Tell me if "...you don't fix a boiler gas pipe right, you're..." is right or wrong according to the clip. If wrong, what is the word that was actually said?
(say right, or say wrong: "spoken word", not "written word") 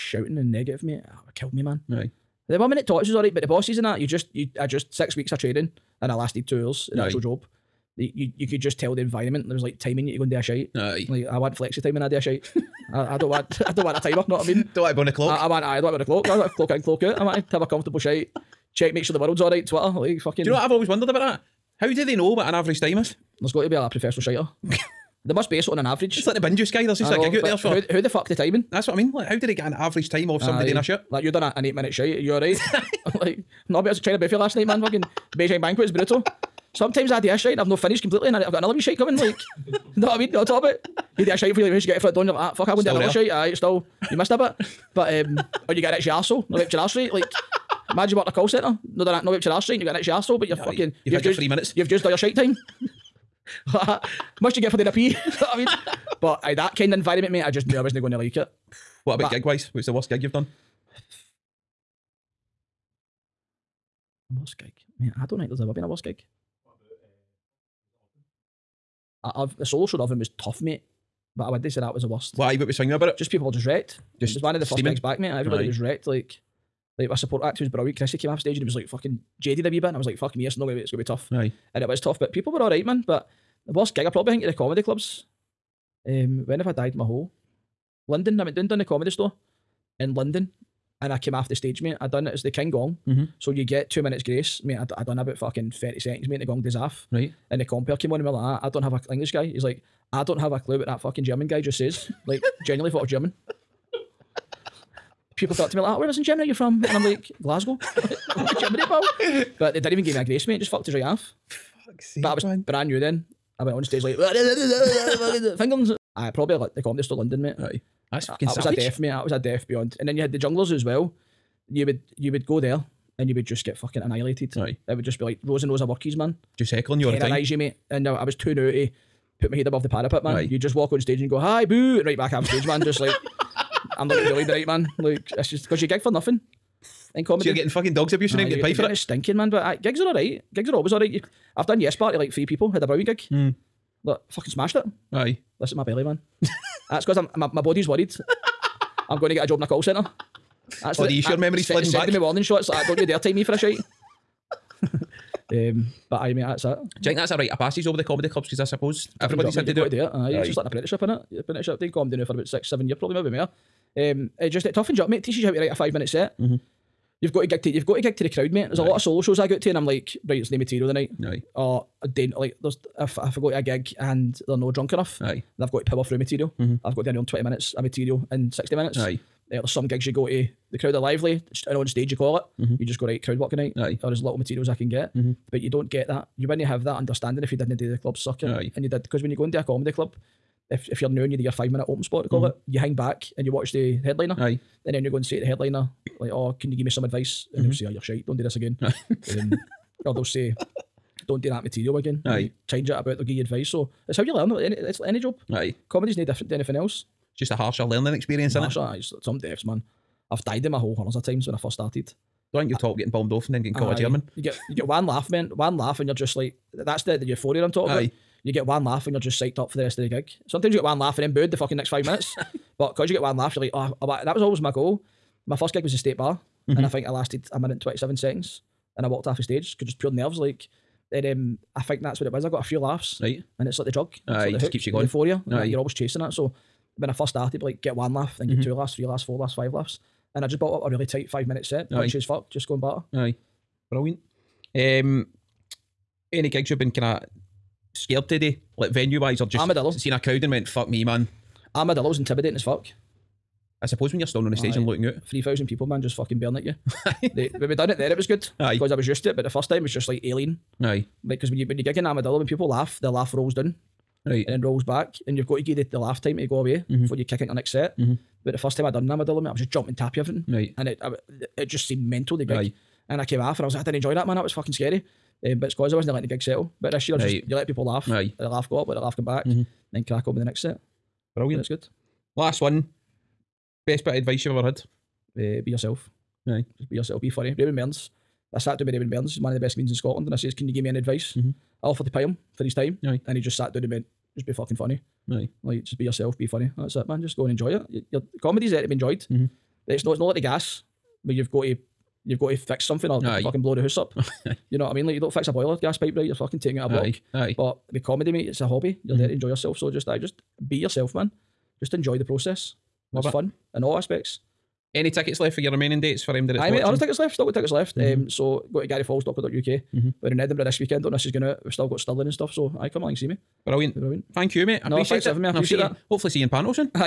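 right.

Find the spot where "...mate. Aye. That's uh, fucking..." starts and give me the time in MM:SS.
01:57.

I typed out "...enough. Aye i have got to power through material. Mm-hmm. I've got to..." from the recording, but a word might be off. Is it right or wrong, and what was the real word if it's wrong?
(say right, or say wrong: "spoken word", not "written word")
right.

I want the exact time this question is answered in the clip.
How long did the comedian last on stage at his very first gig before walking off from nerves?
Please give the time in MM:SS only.
03:47.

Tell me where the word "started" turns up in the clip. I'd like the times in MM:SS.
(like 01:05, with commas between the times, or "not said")
03:31, 03:57.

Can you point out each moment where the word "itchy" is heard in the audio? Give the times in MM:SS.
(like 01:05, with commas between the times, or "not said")
00:45, 00:49.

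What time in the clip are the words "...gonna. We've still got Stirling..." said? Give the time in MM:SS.
05:21.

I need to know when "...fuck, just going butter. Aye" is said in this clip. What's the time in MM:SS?
04:02.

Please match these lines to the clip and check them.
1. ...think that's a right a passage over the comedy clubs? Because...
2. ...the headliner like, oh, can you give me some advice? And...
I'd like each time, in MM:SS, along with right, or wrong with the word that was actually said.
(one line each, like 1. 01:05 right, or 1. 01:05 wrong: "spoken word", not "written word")
1. 02:37 right
2. 03:15 right.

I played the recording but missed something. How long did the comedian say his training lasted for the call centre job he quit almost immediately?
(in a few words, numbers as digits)
6 weeks.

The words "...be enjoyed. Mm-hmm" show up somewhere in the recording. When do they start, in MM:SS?
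04:58.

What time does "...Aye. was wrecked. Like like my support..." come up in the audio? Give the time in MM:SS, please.
01:15.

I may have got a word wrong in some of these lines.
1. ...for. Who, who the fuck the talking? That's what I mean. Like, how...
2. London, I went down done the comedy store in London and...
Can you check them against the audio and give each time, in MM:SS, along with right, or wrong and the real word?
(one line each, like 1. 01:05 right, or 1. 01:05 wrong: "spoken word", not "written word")
1. 00:27 wrong: "timing", not "talking"
2. 01:28 right.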